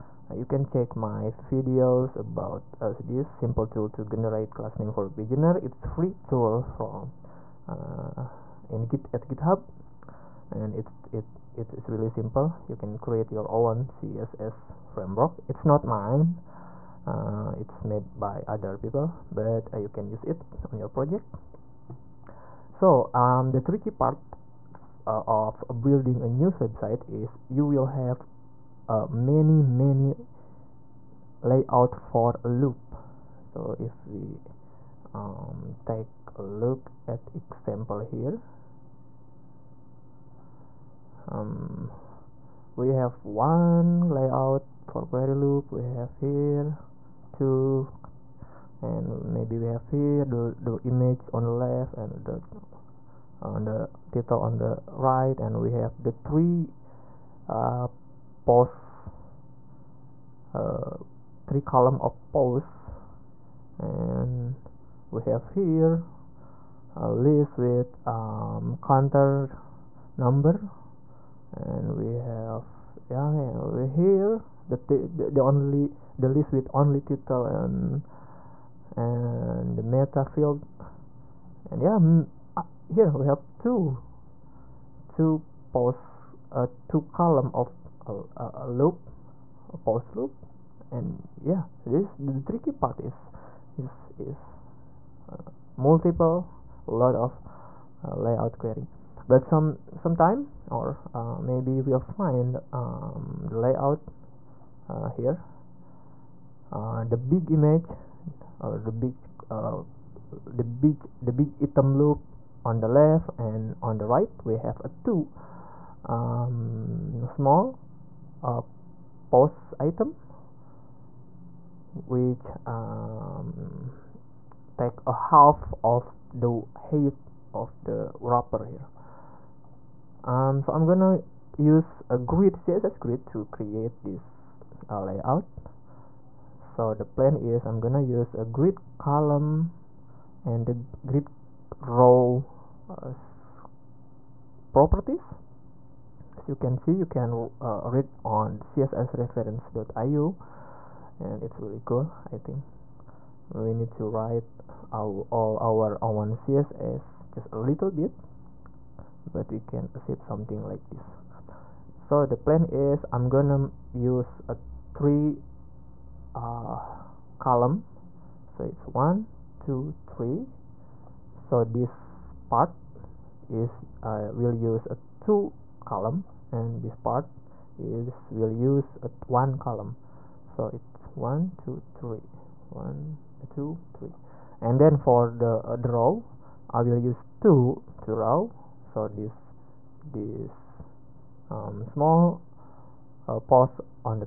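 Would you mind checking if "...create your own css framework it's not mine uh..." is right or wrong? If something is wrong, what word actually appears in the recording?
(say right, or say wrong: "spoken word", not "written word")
right.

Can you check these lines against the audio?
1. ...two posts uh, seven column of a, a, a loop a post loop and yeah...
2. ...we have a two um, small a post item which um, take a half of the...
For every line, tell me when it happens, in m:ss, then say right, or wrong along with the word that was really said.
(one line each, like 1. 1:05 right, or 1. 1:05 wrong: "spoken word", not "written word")
1. 1:25 wrong: "two", not "seven"
2. 1:54 right.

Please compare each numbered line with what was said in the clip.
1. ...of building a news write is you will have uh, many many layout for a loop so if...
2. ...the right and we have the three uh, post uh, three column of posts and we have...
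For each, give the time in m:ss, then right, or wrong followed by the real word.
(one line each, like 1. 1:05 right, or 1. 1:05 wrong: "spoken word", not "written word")
1. 0:25 wrong: "website", not "write"
2. 0:54 right.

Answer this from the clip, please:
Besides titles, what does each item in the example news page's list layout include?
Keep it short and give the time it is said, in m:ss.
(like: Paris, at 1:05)
counter number, at 1:08.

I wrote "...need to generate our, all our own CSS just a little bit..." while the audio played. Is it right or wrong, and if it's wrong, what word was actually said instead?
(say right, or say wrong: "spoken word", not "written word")
wrong: "write", not "generate".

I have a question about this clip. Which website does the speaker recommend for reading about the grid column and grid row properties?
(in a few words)
cssreference.io.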